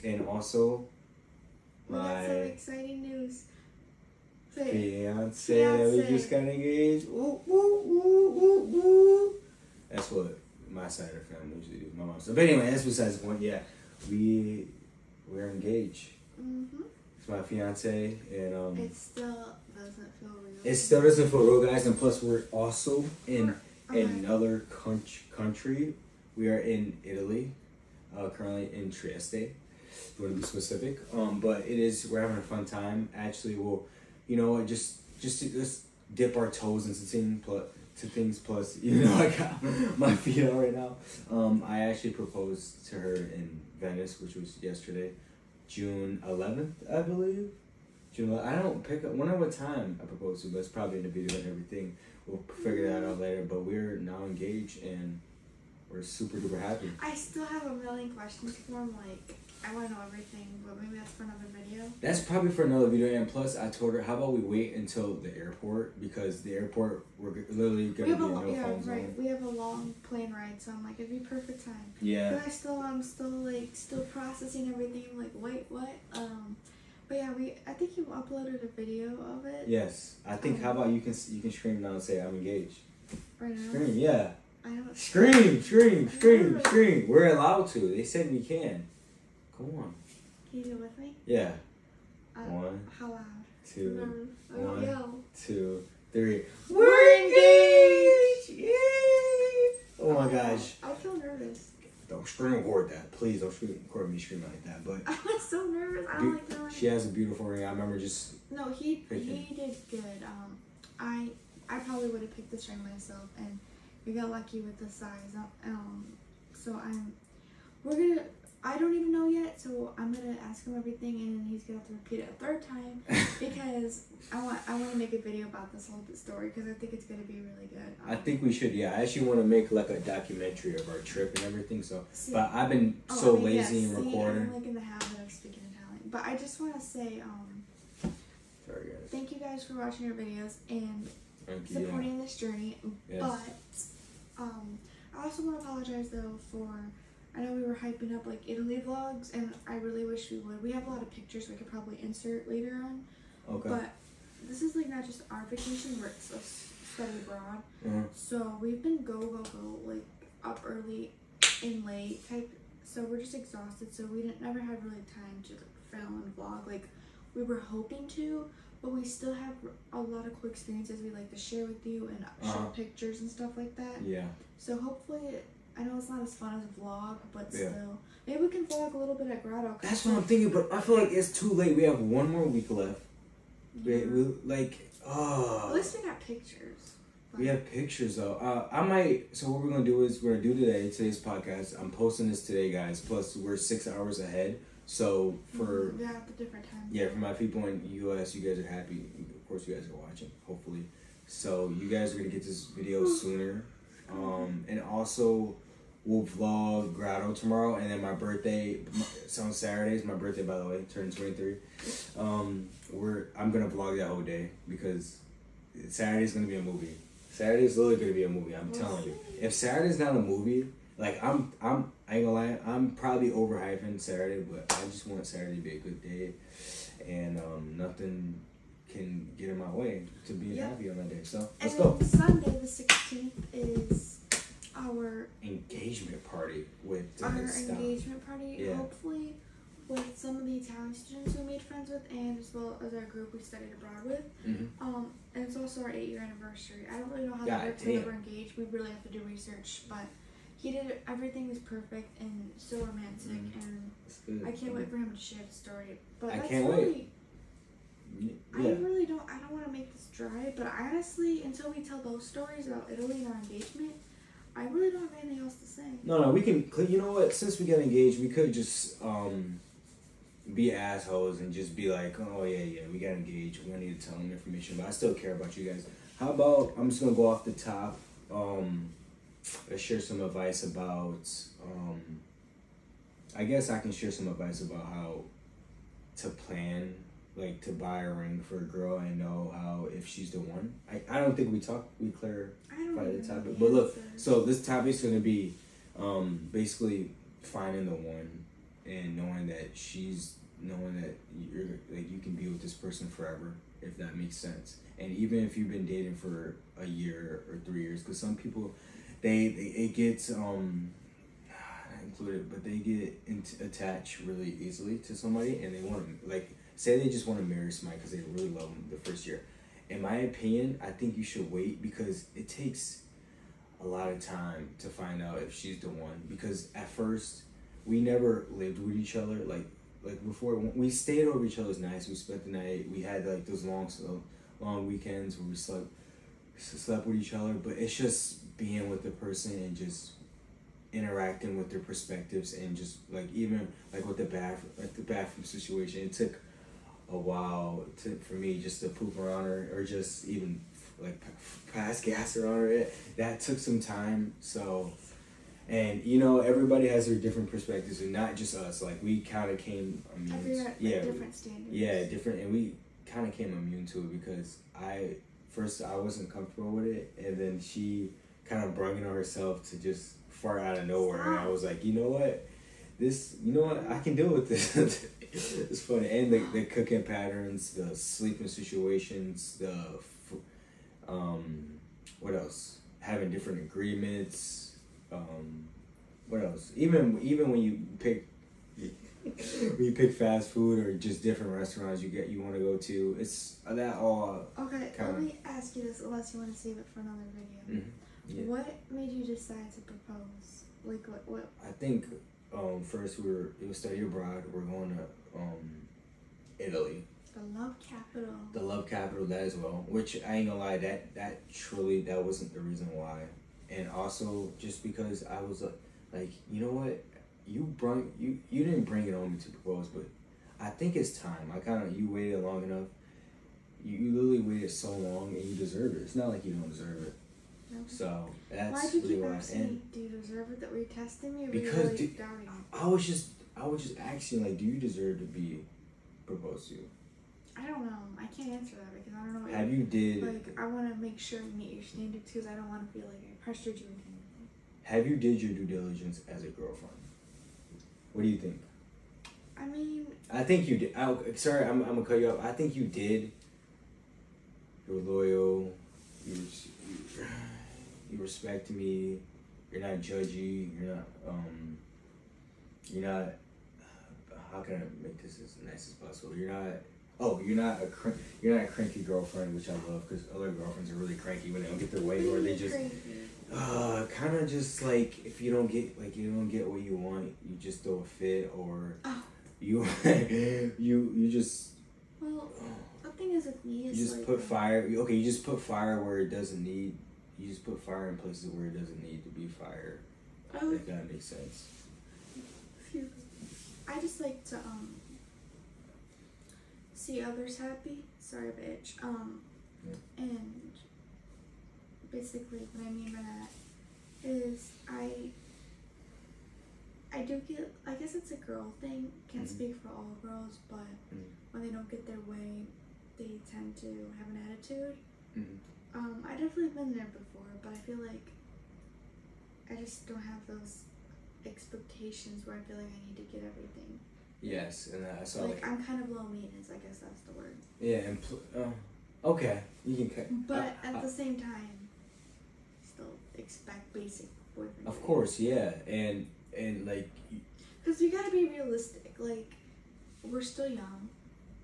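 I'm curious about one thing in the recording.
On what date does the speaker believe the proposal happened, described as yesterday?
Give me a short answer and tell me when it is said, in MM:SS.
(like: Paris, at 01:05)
June 11, at 00:45.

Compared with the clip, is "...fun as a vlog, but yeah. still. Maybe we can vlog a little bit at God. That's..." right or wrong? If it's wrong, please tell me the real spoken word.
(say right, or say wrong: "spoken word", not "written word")
wrong: "Grotto", not "God".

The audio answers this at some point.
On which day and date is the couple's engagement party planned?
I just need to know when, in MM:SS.
03:52.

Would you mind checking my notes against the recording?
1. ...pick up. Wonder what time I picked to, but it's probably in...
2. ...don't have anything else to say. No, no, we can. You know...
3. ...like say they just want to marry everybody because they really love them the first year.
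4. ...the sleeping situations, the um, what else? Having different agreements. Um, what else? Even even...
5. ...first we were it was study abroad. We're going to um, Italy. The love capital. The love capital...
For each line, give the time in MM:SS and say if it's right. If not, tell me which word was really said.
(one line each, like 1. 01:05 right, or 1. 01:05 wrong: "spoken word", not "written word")
1. 00:48 wrong: "proposed", not "picked"
2. 04:24 right
3. 05:16 wrong: "somebody", not "everybody"
4. 06:17 right
5. 06:42 right.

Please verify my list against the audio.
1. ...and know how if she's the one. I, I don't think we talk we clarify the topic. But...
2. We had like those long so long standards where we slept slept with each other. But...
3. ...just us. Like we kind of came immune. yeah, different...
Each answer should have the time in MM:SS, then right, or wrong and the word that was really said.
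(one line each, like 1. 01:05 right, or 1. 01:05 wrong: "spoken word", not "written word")
1. 04:48 right
2. 05:32 wrong: "weekends", not "standards"
3. 05:58 right.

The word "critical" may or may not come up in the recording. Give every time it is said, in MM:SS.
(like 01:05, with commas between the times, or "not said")
not said.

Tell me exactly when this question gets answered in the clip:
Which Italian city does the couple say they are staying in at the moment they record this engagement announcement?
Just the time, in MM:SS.
00:28.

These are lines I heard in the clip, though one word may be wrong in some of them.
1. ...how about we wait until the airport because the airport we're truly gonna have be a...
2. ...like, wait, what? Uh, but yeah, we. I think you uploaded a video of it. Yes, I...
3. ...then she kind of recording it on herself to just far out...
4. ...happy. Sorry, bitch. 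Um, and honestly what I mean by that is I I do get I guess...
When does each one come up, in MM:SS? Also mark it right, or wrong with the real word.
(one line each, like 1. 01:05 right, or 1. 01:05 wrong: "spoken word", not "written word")
1. 01:04 wrong: "literally", not "truly"
2. 01:15 right
3. 06:07 wrong: "brung", not "recording"
4. 08:17 wrong: "basically", not "honestly".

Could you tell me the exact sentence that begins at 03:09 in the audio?
So, what we're going to do is we're going to do today, today's podcast.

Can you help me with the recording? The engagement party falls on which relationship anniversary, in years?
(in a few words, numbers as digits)
8.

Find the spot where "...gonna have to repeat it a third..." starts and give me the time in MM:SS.
02:01.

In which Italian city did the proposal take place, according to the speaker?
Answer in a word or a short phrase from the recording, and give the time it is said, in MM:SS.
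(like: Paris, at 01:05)
Venice, at 00:43.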